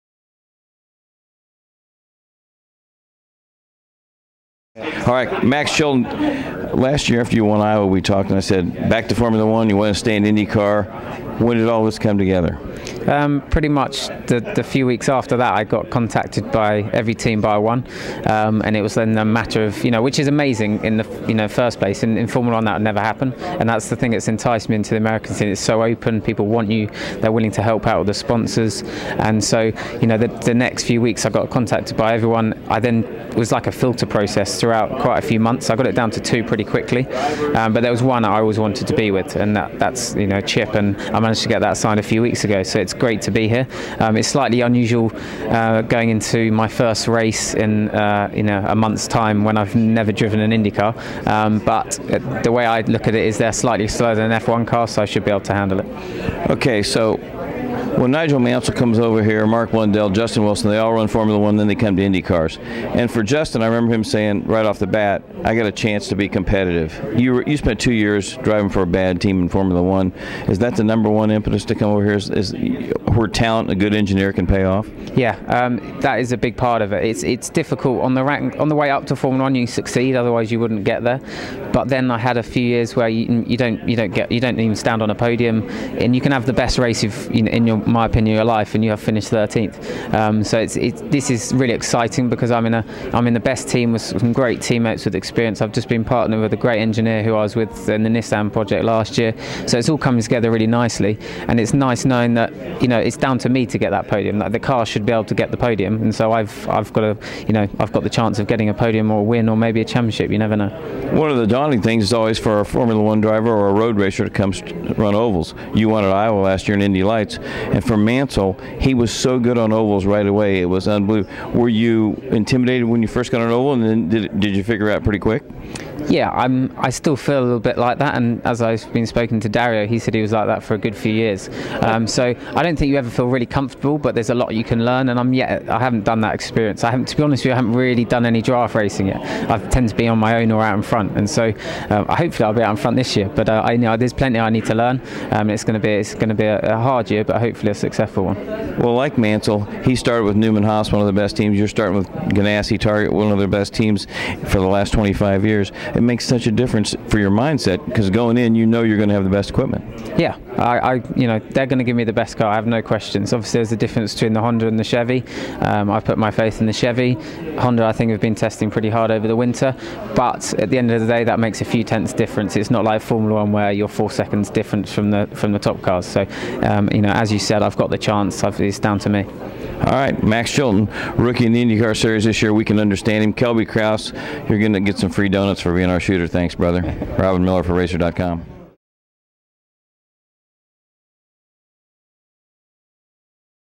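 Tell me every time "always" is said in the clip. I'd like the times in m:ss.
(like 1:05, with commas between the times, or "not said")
0:38, 1:52.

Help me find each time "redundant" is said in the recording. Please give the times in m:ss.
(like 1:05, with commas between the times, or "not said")
not said.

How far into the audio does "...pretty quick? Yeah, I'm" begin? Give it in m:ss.
2:05.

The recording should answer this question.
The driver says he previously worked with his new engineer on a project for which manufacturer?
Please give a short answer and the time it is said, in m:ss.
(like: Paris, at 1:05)
Nissan, at 1:38.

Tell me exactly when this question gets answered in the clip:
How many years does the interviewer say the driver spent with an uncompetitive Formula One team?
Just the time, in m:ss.
1:07.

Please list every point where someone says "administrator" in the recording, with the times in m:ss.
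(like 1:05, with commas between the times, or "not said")
not said.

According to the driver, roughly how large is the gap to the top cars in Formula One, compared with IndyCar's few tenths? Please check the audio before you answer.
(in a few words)
4 seconds.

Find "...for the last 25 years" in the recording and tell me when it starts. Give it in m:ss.
2:34.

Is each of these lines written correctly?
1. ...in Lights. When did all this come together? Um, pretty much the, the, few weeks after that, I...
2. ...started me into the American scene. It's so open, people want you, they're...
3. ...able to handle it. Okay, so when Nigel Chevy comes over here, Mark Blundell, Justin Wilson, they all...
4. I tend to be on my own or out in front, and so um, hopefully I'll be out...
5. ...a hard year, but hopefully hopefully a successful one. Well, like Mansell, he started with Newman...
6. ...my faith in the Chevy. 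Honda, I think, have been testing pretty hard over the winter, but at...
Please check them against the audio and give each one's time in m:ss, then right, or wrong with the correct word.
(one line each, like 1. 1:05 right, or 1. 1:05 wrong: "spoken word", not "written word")
1. 0:10 wrong: "IndyCar", not "Lights"
2. 0:24 wrong: "enticed", not "started"
3. 0:55 wrong: "Mansell", not "Chevy"
4. 2:19 right
5. 2:26 right
6. 2:46 right.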